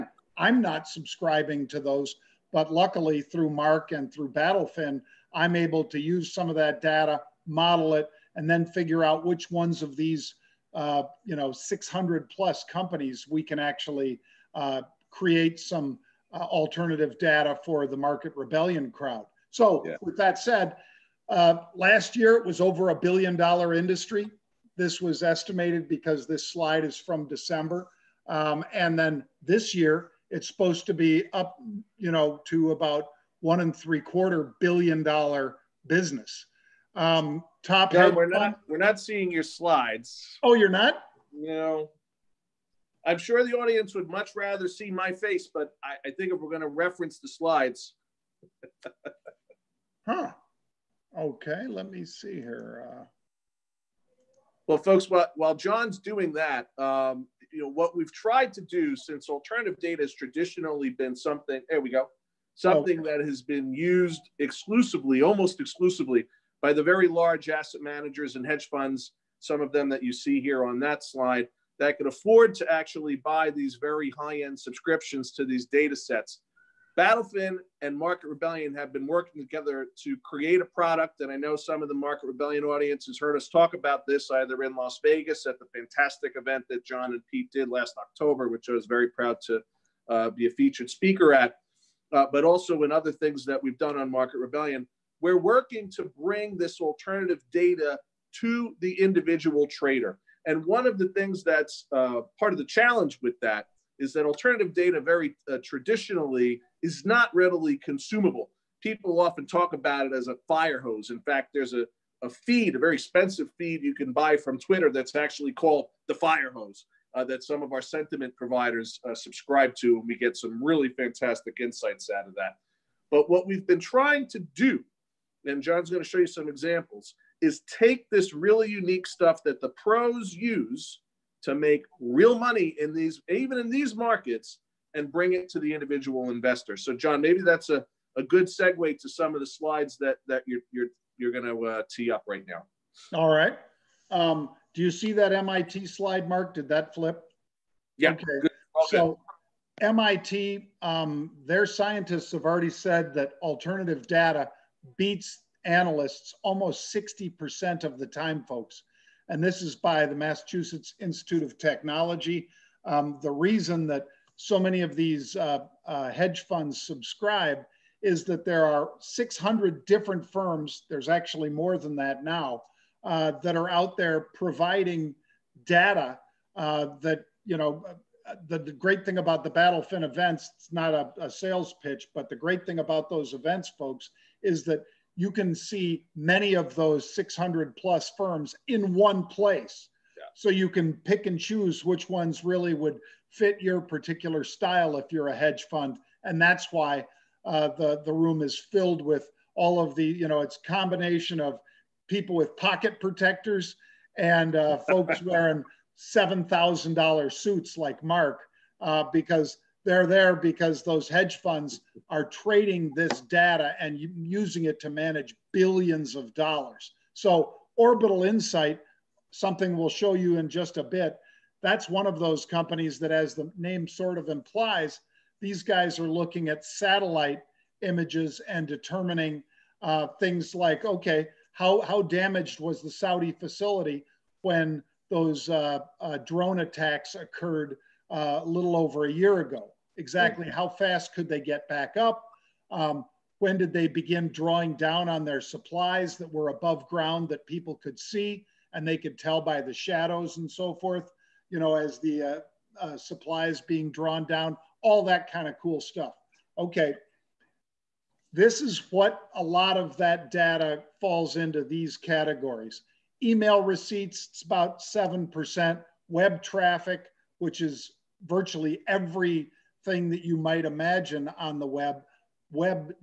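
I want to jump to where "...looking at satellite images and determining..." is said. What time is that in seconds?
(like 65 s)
226 s.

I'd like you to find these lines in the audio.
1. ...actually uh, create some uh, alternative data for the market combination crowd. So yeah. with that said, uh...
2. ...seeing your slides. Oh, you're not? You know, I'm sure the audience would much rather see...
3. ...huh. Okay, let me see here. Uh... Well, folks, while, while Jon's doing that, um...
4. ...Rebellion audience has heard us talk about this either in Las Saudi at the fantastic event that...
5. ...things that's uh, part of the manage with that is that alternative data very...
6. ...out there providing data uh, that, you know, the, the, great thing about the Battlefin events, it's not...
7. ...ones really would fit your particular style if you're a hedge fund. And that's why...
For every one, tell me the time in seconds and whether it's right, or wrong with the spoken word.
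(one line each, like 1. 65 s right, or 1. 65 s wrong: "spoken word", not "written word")
1. 13 s wrong: "rebellion", not "combination"
2. 38 s right
3. 50 s right
4. 82 s wrong: "Vegas", not "Saudi"
5. 101 s wrong: "challenge", not "manage"
6. 173 s right
7. 192 s right.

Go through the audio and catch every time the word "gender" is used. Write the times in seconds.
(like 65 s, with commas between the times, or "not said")
not said.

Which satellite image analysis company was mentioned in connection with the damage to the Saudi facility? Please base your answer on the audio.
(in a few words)
Orbital Insight.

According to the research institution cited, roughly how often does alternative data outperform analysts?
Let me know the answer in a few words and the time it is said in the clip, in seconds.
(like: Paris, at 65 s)
almost 60%, at 156 s.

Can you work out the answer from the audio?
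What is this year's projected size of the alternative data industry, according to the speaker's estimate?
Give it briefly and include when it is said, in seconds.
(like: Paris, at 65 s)
1.75 billion dollars, at 33 s.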